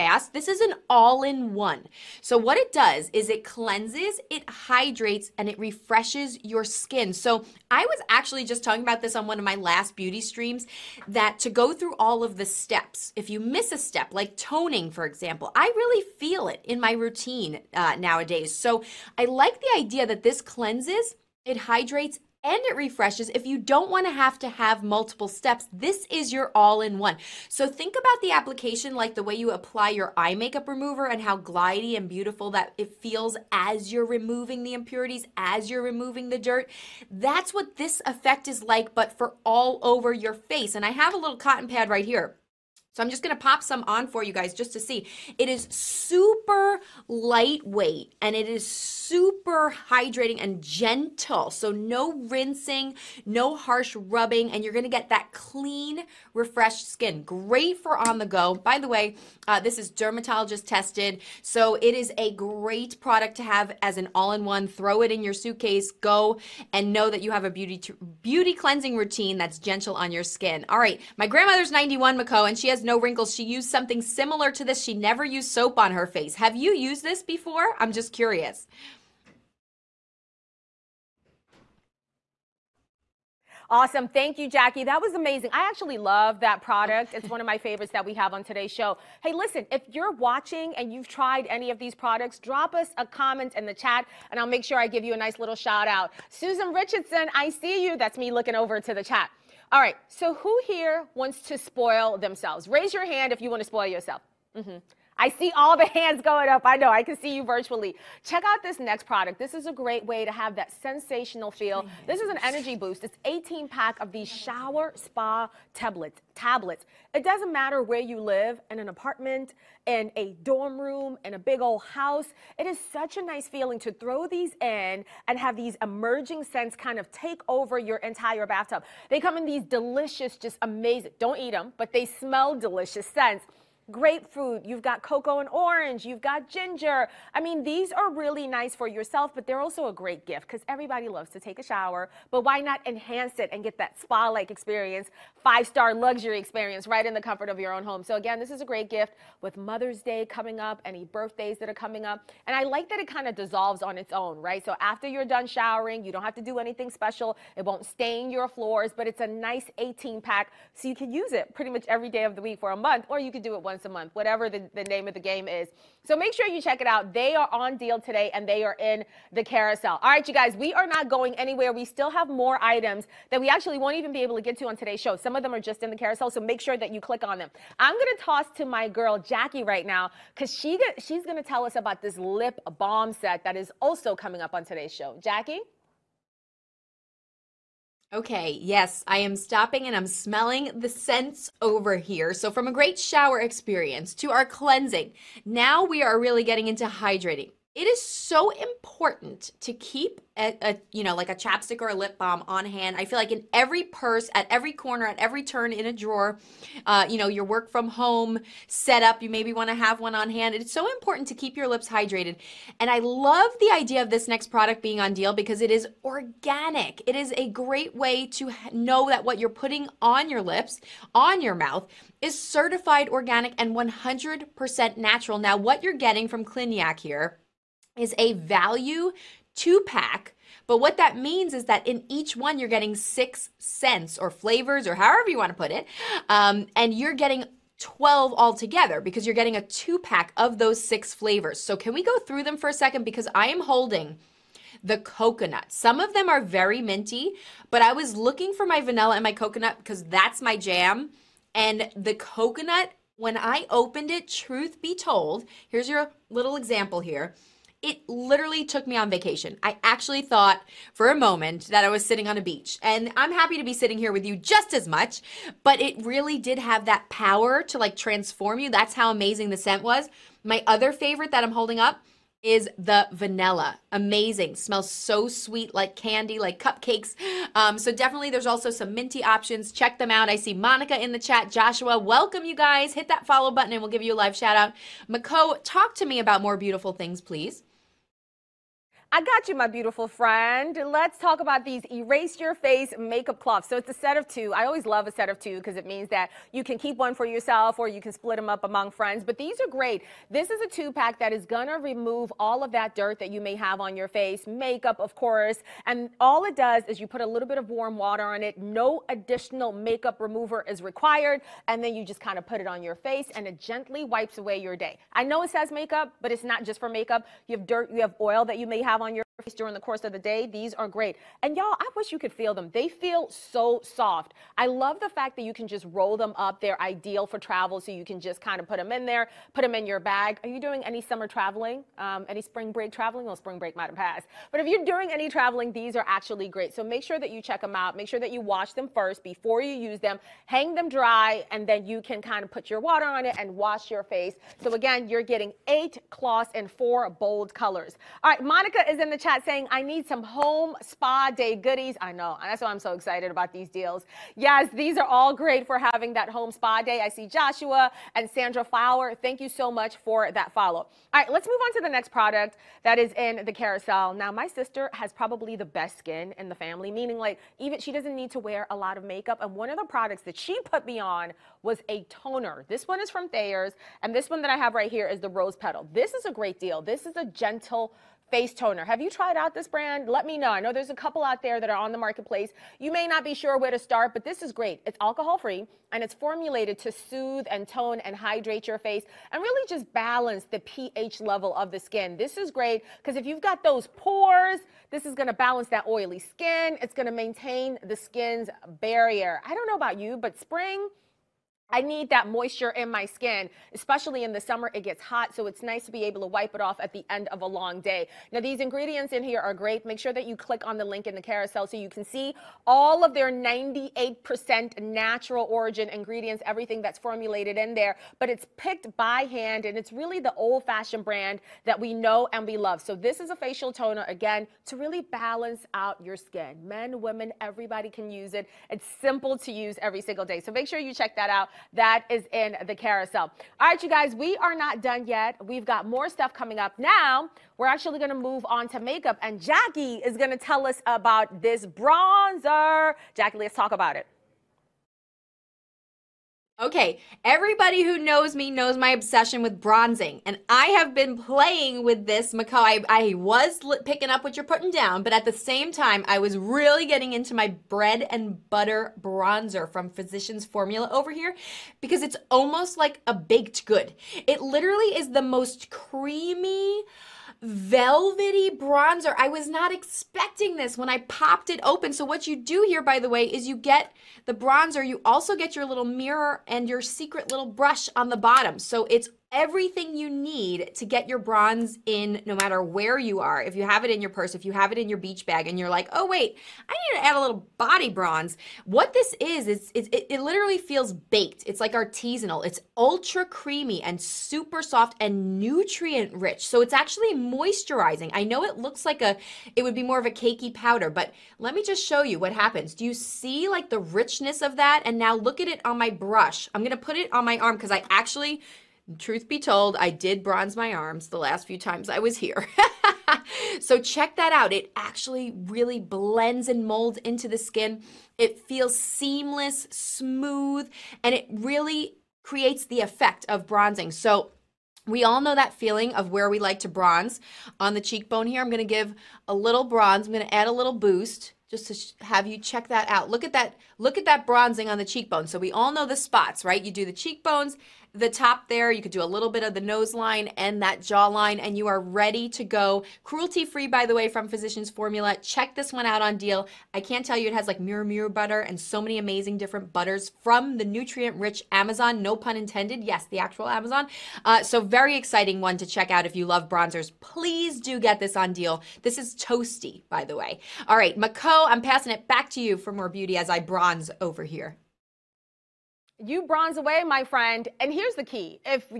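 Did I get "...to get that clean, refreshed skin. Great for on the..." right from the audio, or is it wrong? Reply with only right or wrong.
right.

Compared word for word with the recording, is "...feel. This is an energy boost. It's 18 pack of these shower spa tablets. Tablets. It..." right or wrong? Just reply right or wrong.
right.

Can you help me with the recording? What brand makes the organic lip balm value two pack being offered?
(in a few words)
Cliganic.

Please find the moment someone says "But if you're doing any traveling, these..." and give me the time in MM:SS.
05:34.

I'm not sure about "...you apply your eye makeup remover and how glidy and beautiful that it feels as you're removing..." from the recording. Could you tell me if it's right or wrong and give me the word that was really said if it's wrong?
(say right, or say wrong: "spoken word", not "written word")
right.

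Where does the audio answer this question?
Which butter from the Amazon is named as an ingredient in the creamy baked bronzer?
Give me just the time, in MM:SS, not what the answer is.
09:07.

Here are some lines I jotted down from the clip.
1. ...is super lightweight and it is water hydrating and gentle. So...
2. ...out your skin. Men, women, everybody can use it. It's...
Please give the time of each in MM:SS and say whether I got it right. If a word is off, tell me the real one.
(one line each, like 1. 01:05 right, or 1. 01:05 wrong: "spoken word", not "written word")
1. 00:45 wrong: "super", not "water"
2. 07:05 right.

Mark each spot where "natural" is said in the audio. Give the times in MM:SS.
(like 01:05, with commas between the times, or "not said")
03:44, 06:54.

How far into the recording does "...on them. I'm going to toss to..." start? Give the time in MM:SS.
02:57.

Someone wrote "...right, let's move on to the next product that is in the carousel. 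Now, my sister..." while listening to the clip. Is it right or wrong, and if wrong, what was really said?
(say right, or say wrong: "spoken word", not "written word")
right.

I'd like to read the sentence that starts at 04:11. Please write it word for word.
And the coconut, when I opened it, truth be told, here's your little example here.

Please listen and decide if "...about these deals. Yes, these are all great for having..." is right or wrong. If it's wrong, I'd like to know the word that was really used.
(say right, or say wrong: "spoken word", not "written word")
right.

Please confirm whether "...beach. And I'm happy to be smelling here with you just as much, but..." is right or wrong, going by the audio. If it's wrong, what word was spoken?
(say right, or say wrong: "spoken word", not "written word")
wrong: "sitting", not "smelling".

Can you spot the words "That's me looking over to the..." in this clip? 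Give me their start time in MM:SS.
01:37.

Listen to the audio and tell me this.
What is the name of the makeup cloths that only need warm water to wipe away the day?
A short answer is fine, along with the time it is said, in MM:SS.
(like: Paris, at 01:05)
Erase Your Face, at 04:51.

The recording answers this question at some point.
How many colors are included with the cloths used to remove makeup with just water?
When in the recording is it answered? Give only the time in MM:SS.
05:46.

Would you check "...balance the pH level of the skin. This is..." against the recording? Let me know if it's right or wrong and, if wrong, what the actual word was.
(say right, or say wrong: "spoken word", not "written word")
right.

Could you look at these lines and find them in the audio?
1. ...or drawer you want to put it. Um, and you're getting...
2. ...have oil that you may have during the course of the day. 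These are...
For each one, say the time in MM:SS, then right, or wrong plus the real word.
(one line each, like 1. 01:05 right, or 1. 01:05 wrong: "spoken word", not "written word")
1. 03:54 wrong: "however", not "drawer"
2. 05:18 right.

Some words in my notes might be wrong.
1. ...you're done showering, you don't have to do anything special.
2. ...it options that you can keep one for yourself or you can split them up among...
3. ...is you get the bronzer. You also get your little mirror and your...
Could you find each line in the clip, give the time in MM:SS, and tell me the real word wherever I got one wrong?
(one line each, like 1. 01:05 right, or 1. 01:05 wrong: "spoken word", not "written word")
1. 02:35 right
2. 04:55 wrong: "means", not "options"
3. 07:53 right.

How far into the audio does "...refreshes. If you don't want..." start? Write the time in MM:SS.
00:22.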